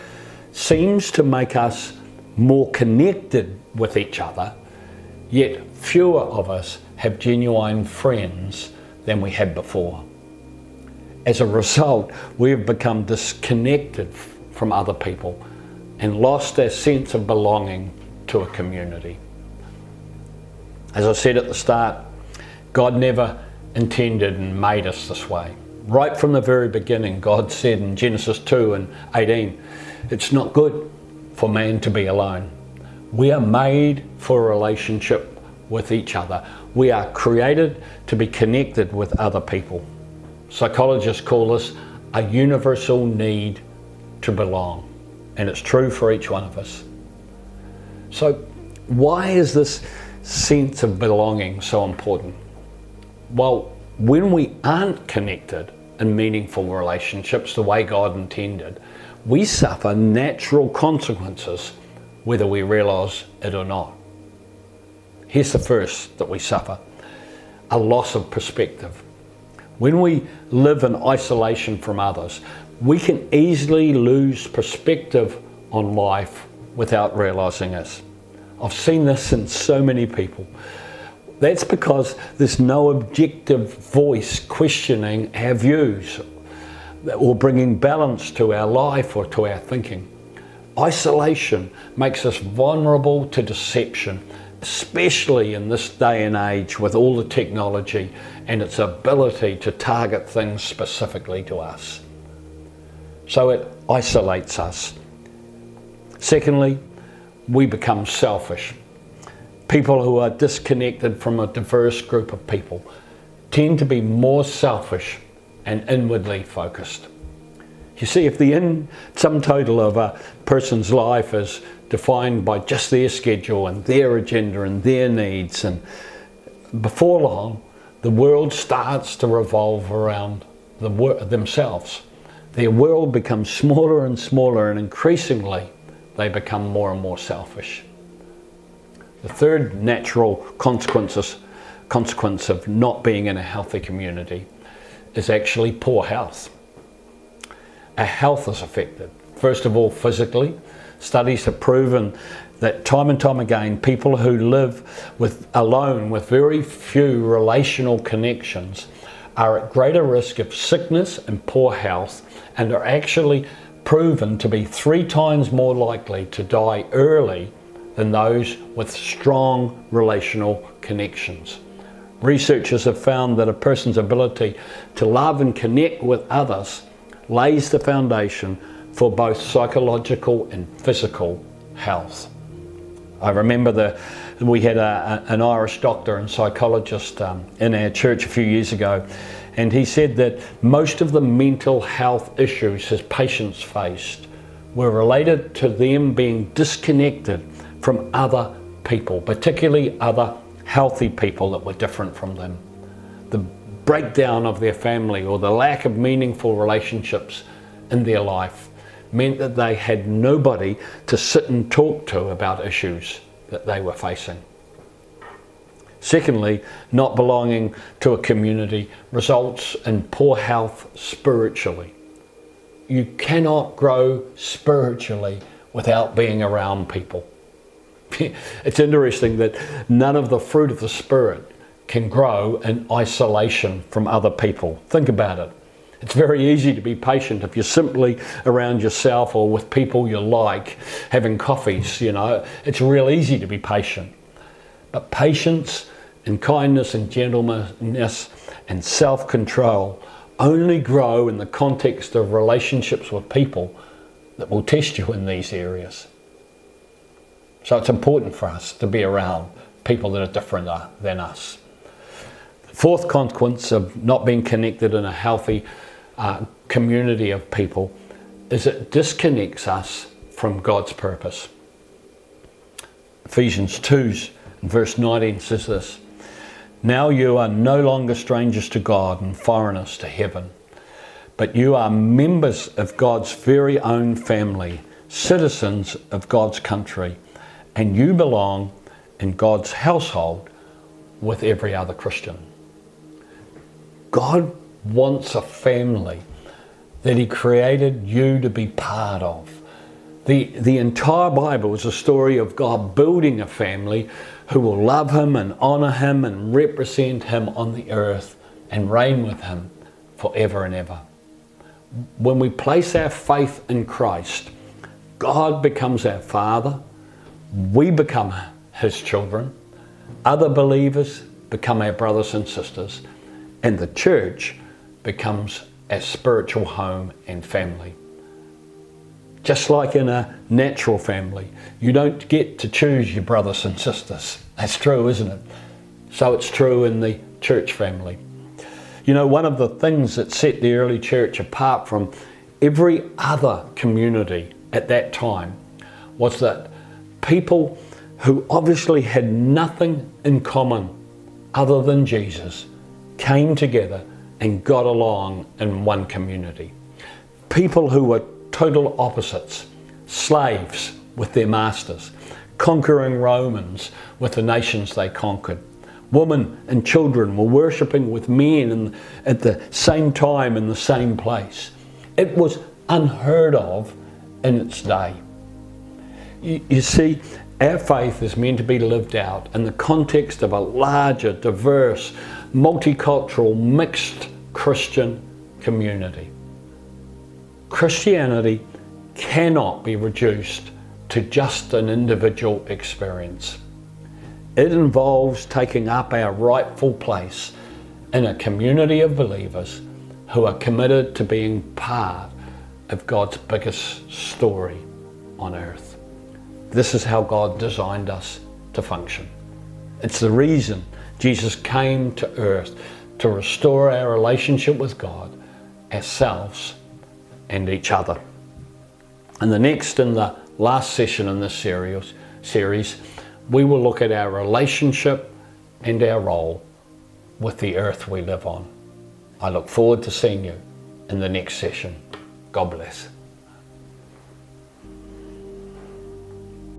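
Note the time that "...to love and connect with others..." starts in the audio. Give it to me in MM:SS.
02:54.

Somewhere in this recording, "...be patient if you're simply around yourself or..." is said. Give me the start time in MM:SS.
03:56.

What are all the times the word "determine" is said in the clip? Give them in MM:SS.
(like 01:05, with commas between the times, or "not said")
not said.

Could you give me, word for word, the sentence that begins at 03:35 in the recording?
Secondly, not belonging to a community results in poor health spiritually.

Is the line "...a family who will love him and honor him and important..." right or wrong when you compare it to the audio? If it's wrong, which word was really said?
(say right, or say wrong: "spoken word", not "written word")
wrong: "represent", not "important".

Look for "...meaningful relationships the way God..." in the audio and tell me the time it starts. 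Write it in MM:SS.
00:56.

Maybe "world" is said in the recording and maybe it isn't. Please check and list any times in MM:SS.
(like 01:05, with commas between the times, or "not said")
02:08, 02:12.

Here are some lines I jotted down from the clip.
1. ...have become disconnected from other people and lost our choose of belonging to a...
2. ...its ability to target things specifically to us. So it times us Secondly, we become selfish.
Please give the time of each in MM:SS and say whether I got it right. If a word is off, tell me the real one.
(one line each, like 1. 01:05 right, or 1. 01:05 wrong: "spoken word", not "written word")
1. 00:12 wrong: "sense", not "choose"
2. 01:38 wrong: "isolates", not "times".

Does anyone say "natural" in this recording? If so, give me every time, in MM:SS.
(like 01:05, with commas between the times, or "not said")
00:59, 02:19, 05:30.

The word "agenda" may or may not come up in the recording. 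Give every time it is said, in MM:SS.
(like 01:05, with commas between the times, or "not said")
02:04.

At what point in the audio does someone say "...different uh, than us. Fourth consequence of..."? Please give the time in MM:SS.
04:20.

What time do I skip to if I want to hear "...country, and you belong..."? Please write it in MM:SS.
04:46.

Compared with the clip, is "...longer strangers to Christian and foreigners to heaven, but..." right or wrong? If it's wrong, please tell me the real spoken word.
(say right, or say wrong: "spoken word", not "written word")
wrong: "God", not "Christian".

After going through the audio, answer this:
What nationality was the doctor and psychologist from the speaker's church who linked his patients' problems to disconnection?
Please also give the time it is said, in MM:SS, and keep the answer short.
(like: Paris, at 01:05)
Irish, at 03:05.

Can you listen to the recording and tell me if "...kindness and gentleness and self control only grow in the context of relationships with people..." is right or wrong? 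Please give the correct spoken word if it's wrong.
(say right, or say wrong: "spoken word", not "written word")
right.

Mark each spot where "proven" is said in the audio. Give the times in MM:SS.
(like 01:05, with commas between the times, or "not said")
02:31, 02:43.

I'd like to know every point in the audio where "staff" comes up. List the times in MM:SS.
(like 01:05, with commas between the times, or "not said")
not said.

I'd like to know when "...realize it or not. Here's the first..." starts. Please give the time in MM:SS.
01:02.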